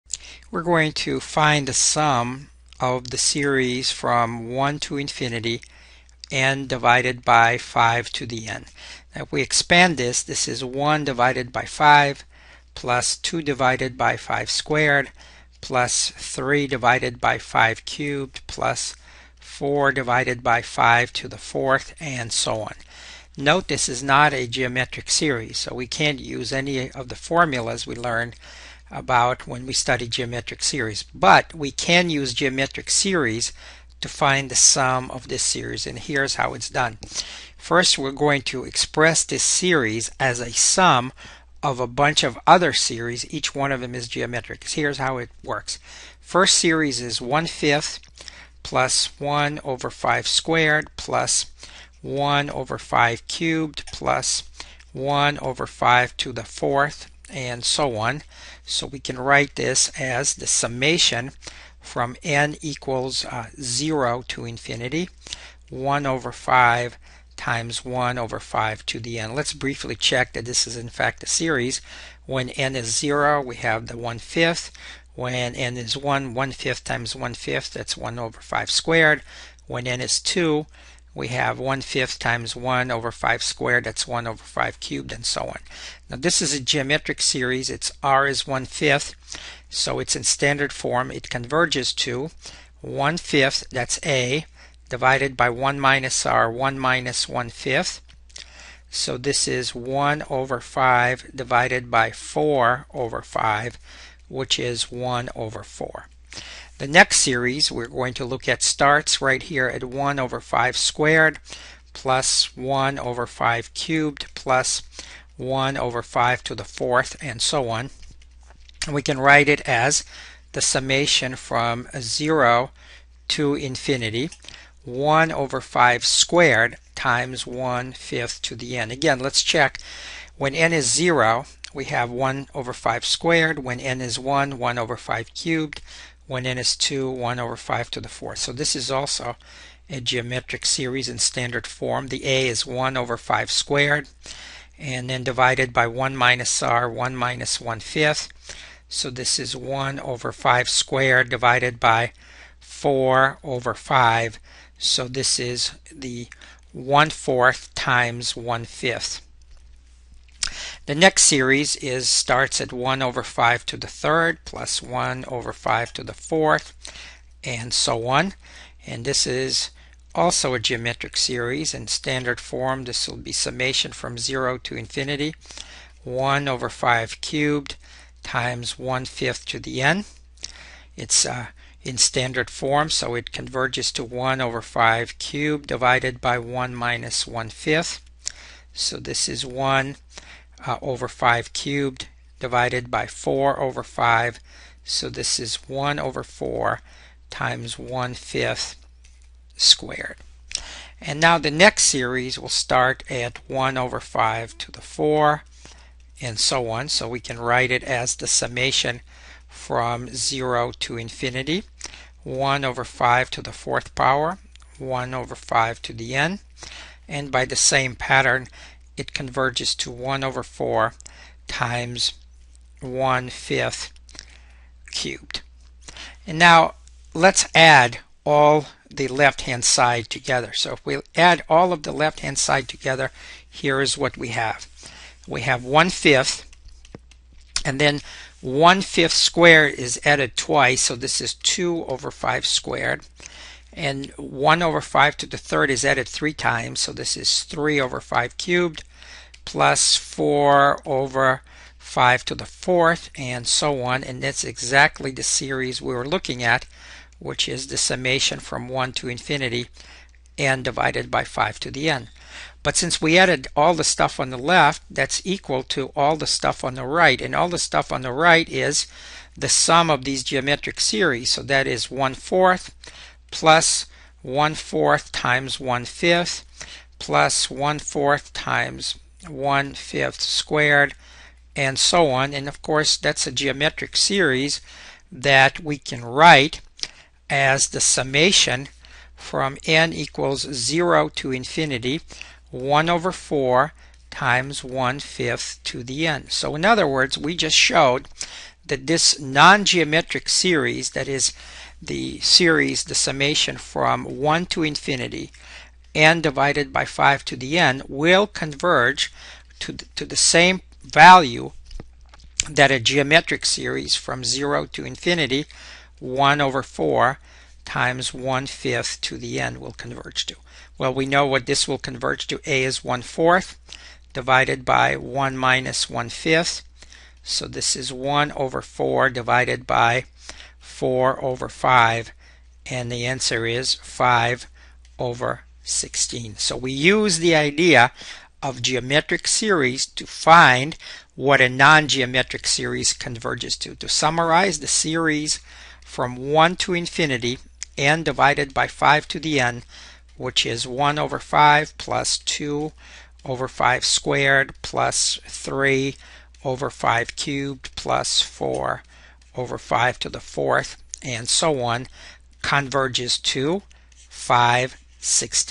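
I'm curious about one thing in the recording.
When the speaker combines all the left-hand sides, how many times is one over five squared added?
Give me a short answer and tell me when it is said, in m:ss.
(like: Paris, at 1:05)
twice, at 4:00.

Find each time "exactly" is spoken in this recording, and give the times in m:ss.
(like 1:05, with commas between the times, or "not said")
4:14.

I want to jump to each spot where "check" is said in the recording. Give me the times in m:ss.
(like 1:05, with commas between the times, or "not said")
1:09, 2:09.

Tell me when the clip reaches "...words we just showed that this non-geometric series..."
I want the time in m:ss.
4:56.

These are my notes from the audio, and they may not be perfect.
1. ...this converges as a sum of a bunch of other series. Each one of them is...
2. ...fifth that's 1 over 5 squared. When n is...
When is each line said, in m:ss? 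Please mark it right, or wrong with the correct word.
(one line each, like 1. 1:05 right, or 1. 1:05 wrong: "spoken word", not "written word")
1. 0:39 wrong: "series", not "converges"
2. 1:17 right.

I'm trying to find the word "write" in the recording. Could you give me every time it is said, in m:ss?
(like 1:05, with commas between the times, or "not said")
0:59, 1:59, 3:27, 4:46.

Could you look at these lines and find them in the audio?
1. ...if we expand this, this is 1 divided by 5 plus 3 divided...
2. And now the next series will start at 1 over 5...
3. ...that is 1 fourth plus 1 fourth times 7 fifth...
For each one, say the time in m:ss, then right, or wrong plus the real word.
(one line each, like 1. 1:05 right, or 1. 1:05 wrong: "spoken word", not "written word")
1. 0:09 wrong: "2", not "3"
2. 3:20 right
3. 4:31 wrong: "1", not "7".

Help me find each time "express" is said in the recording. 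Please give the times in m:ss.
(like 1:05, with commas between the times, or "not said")
0:38.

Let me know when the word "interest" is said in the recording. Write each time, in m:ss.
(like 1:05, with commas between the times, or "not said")
not said.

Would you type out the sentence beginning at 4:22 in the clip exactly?
But since we added all the stuff on the left, that's equal to all the stuff on the right.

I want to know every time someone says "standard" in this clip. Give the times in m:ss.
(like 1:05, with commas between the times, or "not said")
1:30, 2:21, 2:51, 3:01.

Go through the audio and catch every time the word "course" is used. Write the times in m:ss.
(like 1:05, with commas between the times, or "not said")
4:42.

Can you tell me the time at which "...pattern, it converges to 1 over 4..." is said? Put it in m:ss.
3:37.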